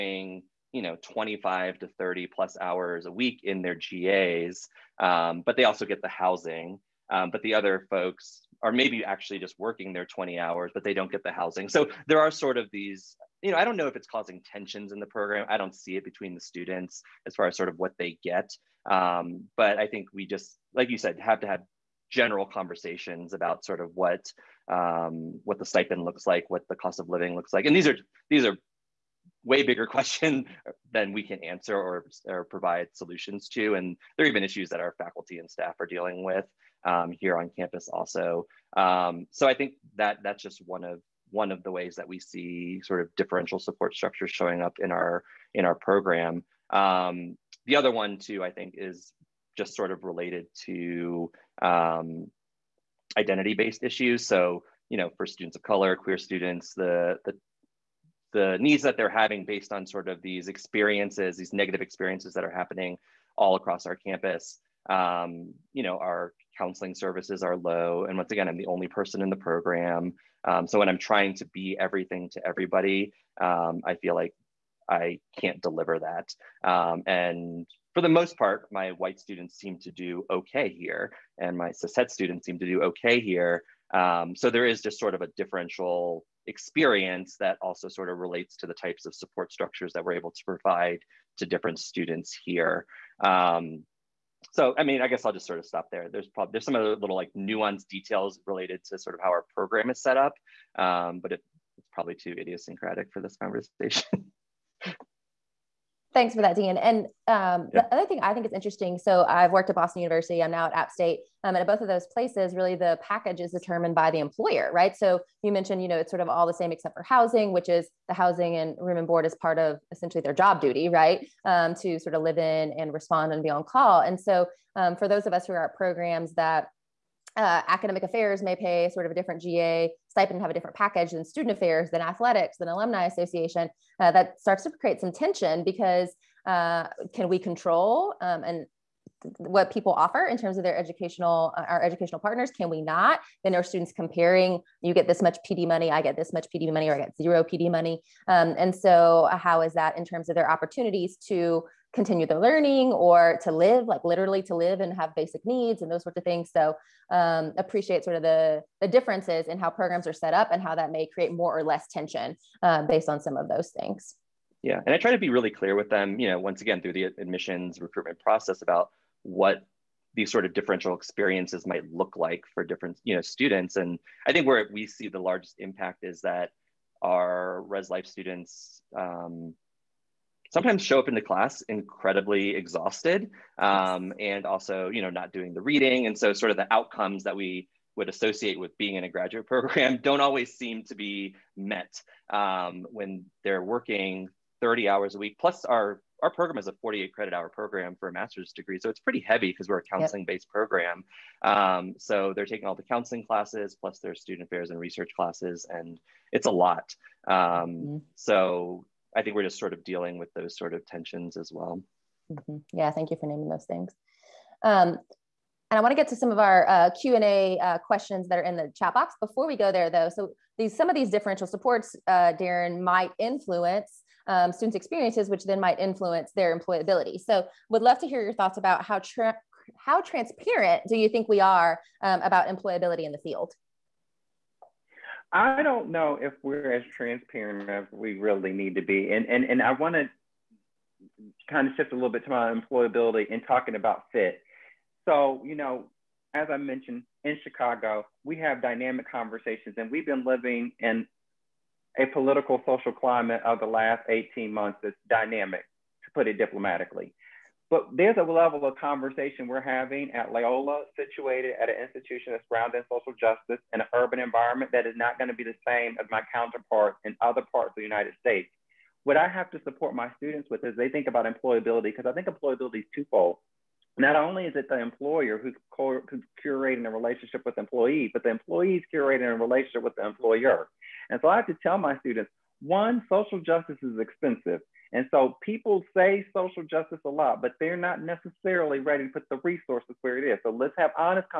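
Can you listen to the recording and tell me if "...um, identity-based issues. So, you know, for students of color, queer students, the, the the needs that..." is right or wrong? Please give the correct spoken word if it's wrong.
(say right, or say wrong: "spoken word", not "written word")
right.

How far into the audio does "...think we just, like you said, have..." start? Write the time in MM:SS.
00:19.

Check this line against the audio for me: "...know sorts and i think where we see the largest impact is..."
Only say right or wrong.
wrong.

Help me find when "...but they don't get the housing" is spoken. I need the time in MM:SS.
00:10.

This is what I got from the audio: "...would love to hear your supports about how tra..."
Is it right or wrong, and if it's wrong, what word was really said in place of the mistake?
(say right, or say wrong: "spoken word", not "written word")
wrong: "thoughts", not "supports".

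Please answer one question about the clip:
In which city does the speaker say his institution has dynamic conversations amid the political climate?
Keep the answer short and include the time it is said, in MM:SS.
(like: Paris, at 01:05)
Chicago, at 04:07.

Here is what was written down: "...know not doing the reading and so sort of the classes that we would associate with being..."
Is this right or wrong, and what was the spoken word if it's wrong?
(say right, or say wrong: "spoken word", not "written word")
wrong: "outcomes", not "classes".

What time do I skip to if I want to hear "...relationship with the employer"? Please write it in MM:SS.
04:39.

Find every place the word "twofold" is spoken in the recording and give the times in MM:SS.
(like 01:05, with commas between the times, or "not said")
04:32.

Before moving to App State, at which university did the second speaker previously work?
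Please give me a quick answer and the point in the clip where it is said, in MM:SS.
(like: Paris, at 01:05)
Boston University, at 01:49.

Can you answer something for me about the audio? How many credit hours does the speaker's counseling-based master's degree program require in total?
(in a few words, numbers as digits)
48.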